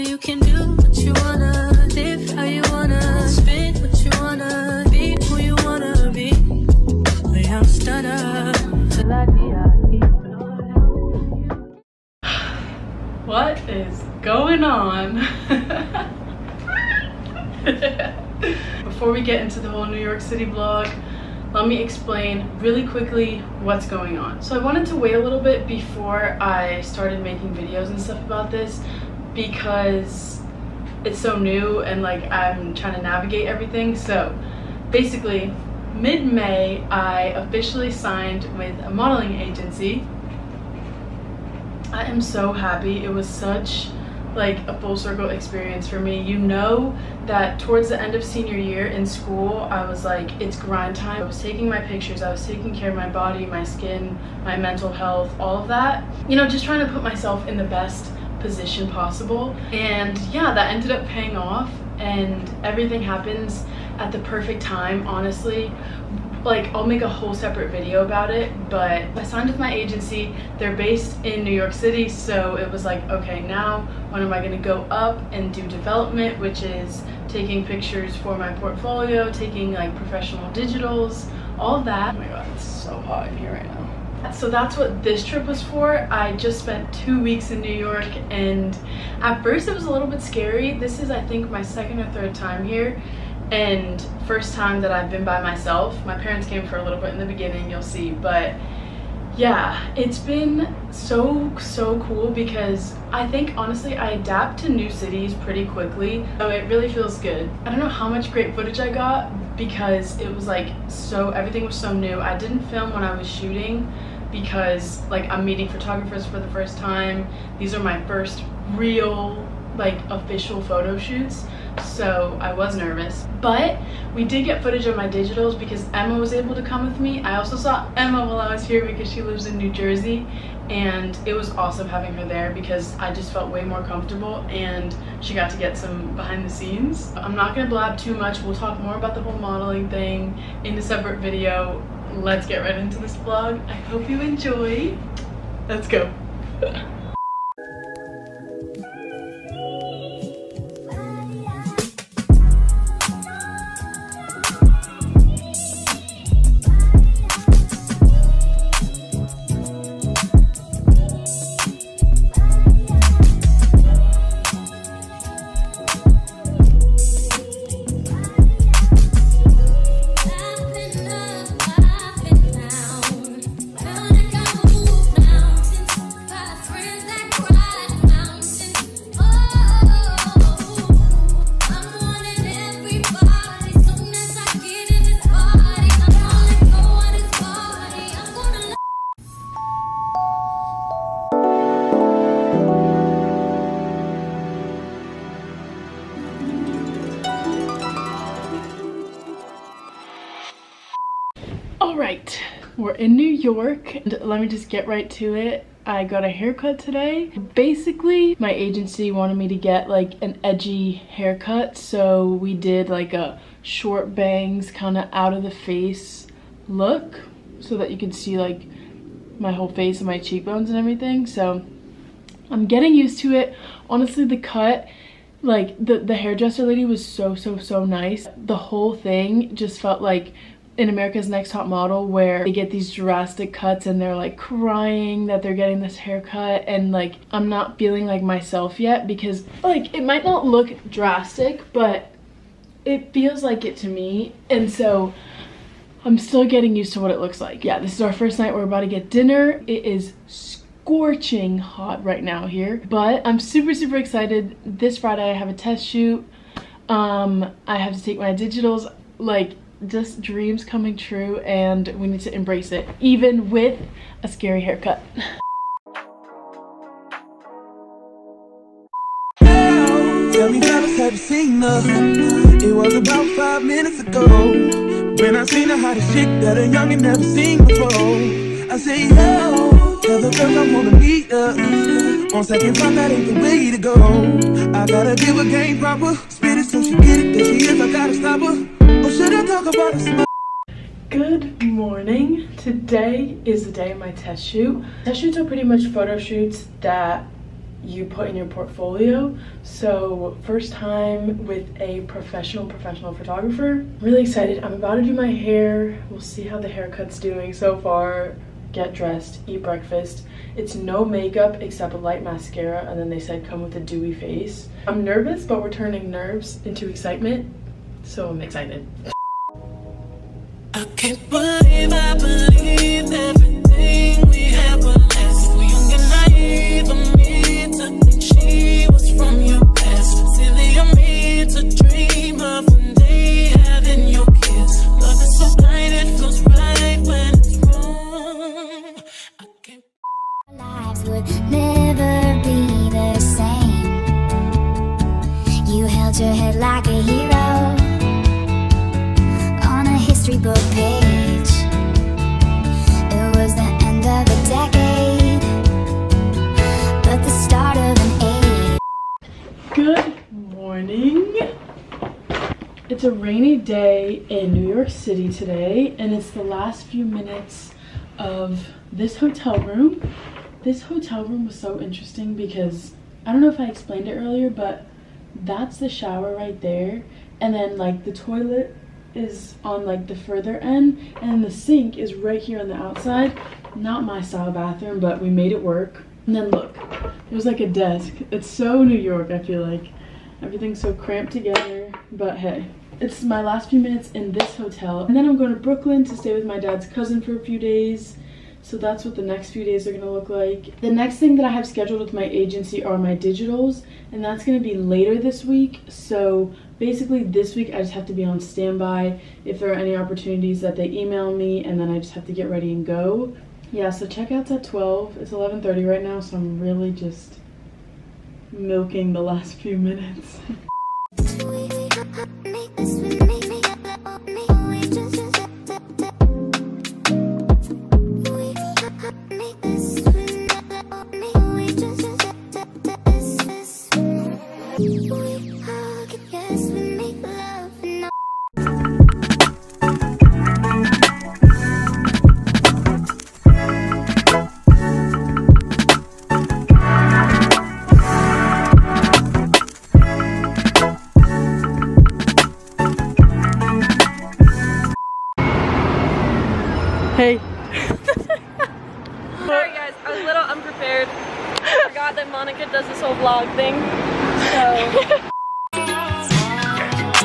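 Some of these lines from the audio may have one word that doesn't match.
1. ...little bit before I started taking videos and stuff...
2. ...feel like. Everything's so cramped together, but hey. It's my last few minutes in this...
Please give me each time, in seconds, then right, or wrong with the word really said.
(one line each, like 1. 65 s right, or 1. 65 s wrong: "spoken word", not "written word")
1. 25 s wrong: "making", not "taking"
2. 389 s right.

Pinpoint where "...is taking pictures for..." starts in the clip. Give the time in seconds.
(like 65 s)
76 s.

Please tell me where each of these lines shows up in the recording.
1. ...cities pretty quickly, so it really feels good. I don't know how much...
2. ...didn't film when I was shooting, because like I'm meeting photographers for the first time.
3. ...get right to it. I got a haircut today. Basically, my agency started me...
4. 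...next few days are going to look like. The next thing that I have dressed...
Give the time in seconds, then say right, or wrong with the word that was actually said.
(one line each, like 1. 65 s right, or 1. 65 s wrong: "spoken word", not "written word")
1. 104 s right
2. 112 s right
3. 204 s wrong: "wanted", not "started"
4. 399 s wrong: "scheduled", not "dressed".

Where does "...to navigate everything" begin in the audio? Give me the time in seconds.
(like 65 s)
32 s.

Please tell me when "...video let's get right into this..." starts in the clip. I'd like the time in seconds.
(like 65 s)
141 s.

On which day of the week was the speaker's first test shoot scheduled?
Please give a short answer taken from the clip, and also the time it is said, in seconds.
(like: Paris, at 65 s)
Friday, at 254 s.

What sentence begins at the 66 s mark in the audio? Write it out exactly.
Like, I'll make a whole separate video about it, but I signed with my agency.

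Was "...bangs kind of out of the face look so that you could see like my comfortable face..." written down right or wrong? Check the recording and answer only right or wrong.
wrong.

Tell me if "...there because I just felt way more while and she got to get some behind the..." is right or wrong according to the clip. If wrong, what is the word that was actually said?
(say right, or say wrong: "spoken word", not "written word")
wrong: "comfortable", not "while".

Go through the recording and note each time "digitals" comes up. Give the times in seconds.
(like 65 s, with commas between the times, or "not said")
80 s, 125 s, 258 s, 403 s.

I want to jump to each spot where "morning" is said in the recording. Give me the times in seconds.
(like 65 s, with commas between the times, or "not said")
291 s, 360 s.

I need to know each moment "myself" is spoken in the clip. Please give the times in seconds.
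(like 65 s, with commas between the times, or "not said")
57 s, 95 s, 238 s.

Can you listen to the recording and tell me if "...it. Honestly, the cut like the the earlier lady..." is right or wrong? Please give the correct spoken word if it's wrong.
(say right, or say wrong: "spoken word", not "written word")
wrong: "hairdresser", not "earlier".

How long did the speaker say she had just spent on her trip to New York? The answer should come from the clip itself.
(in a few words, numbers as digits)
2 weeks.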